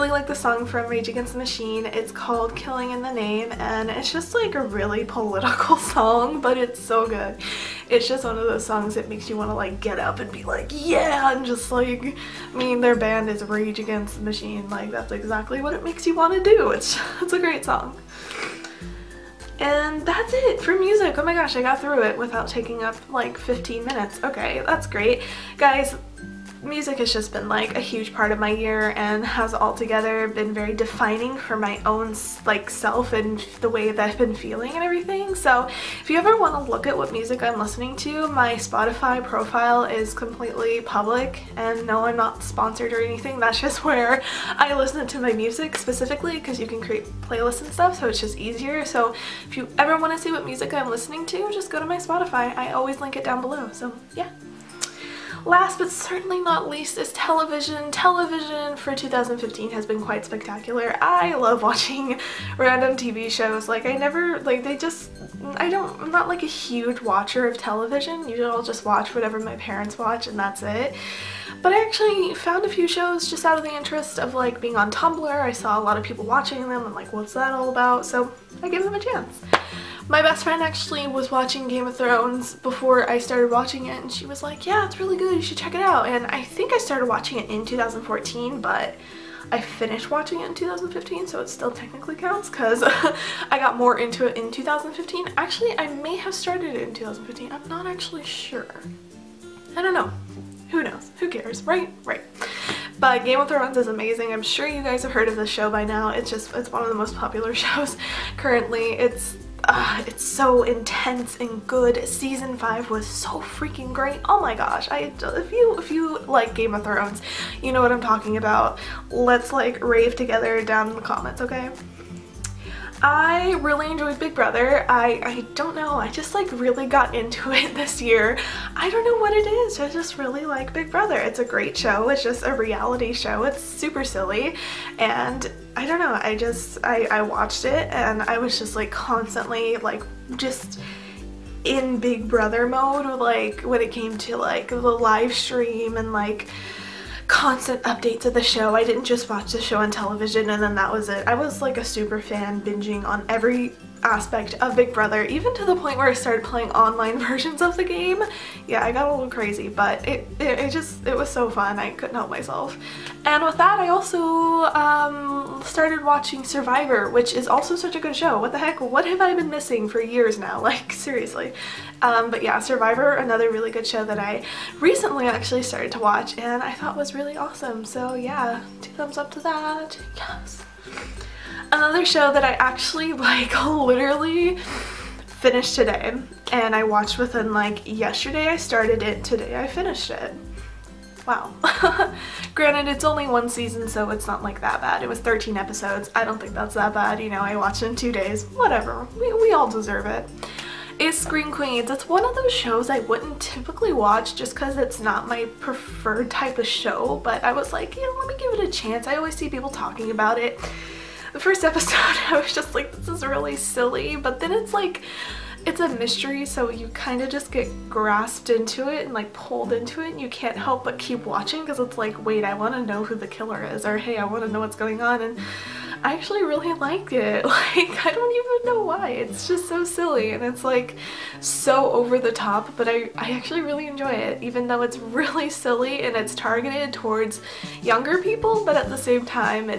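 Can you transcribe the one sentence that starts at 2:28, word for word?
I didn't just watch the show on television and then that was it.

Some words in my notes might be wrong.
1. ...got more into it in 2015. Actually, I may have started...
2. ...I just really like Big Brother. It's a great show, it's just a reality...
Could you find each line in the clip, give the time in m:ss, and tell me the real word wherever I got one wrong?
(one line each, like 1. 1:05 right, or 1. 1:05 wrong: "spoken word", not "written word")
1. 1:33 right
2. 2:09 right.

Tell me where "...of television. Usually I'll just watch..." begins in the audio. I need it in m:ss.
1:07.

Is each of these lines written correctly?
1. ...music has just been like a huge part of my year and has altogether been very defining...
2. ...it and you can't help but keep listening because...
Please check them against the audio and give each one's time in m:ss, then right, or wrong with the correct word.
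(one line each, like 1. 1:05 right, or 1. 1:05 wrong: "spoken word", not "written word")
1. 0:26 right
2. 3:40 wrong: "watching", not "listening".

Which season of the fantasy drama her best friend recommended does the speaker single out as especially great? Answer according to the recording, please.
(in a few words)
Season 5.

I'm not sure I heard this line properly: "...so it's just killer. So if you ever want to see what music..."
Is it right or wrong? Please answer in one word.
wrong.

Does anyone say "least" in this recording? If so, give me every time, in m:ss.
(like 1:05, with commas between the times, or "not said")
0:56.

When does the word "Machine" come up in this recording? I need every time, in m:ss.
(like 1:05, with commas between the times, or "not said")
0:01, 0:14.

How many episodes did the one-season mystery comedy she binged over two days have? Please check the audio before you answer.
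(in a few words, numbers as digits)
13.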